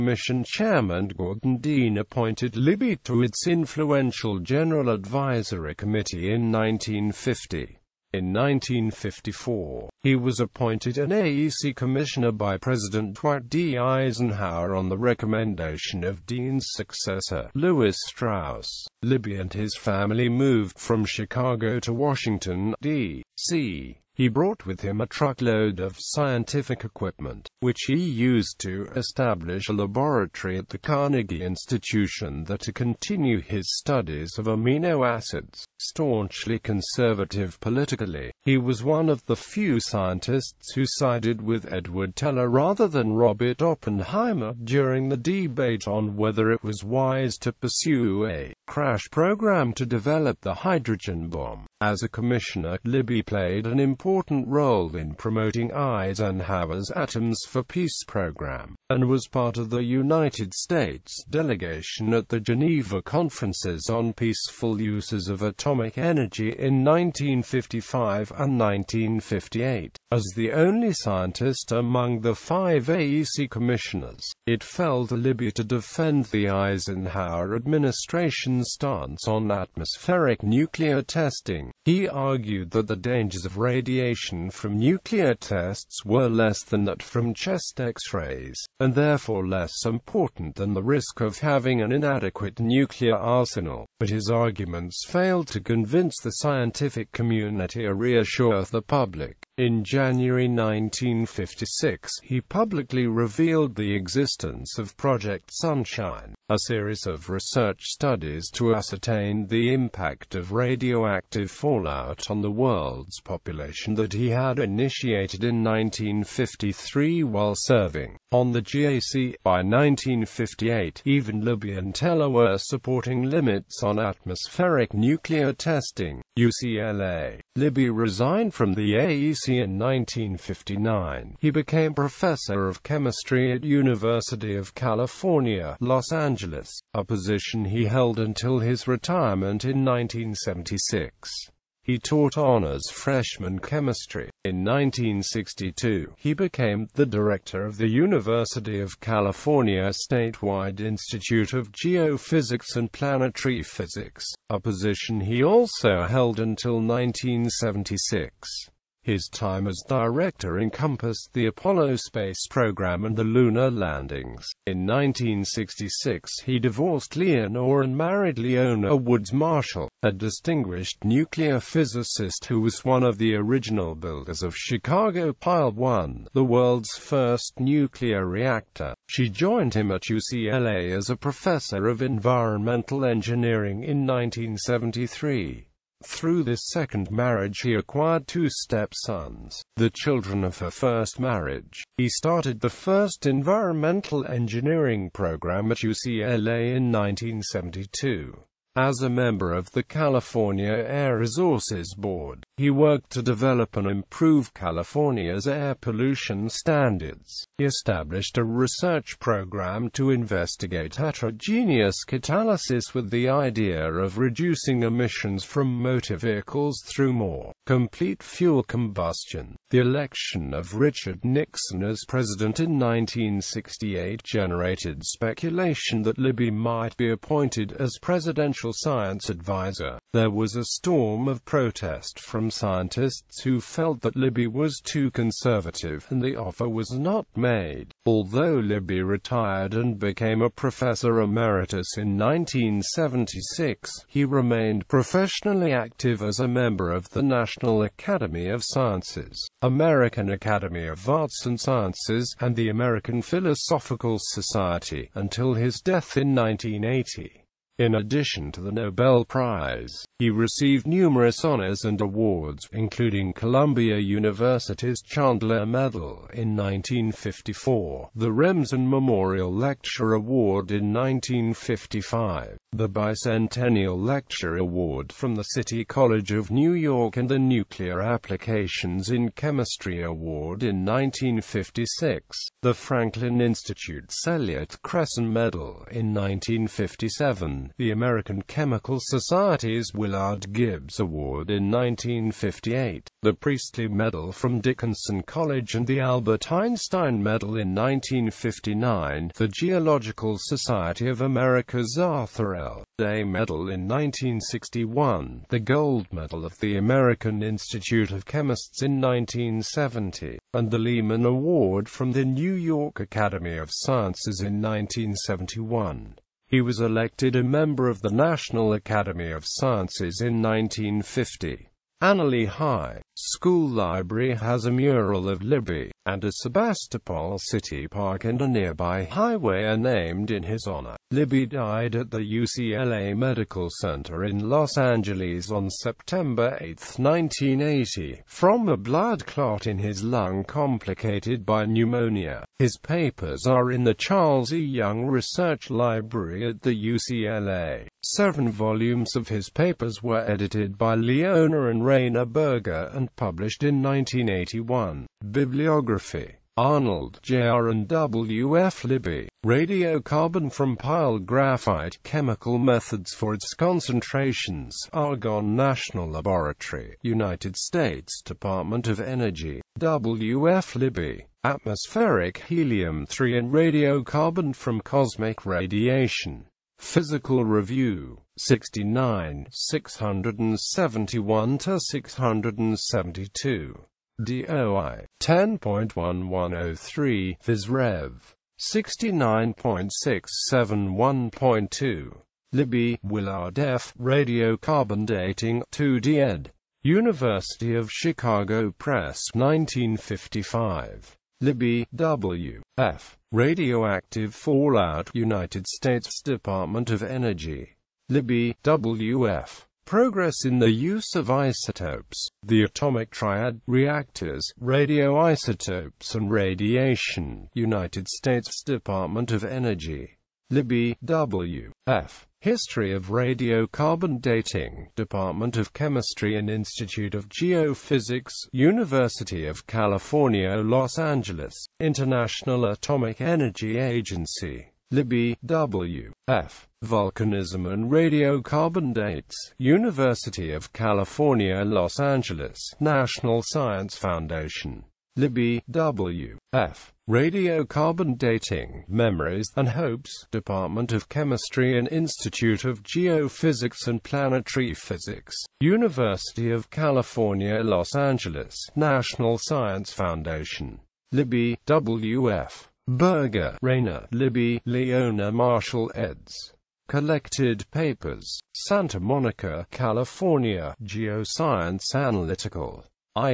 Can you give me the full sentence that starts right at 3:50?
There was a storm of protest from scientists who felt that Libby was too conservative, and the offer was not made.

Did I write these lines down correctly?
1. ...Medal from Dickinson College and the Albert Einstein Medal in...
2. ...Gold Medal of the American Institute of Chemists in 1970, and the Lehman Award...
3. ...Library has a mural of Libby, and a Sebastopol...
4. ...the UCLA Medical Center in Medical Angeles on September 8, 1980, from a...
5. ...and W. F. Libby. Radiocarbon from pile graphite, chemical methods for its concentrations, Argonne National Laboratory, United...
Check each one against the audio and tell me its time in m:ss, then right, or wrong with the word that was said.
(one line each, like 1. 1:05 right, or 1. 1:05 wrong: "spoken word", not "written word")
1. 4:53 right
2. 5:05 right
3. 5:23 right
4. 5:32 wrong: "Los", not "Medical"
5. 5:57 right.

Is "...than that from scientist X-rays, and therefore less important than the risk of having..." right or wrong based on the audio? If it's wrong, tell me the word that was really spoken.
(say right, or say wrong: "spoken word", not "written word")
wrong: "chest", not "scientist".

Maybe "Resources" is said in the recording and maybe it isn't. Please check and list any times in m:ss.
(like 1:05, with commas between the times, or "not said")
3:21.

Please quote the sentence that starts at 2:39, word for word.
His time as director encompassed the Apollo space program and the lunar landings.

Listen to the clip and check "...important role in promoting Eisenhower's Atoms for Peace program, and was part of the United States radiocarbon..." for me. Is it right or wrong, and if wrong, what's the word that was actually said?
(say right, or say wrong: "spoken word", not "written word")
wrong: "delegation", not "radiocarbon".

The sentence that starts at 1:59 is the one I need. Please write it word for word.
By 1958, even Libby and Teller were supporting limits on atmospheric nuclear testing.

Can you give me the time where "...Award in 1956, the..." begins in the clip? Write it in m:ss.
4:40.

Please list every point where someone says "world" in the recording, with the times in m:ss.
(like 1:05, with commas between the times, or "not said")
1:52, 2:56.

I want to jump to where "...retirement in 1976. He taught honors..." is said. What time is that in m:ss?
2:18.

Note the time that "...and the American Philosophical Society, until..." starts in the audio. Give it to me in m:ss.
4:12.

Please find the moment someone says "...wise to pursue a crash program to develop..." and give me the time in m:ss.
0:46.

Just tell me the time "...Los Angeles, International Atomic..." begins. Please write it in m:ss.
7:10.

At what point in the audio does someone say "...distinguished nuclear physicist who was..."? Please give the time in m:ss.
2:50.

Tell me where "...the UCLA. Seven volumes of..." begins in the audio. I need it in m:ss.
5:46.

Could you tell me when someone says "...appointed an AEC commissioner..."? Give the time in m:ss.
0:10.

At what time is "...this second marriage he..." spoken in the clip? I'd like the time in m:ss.
3:06.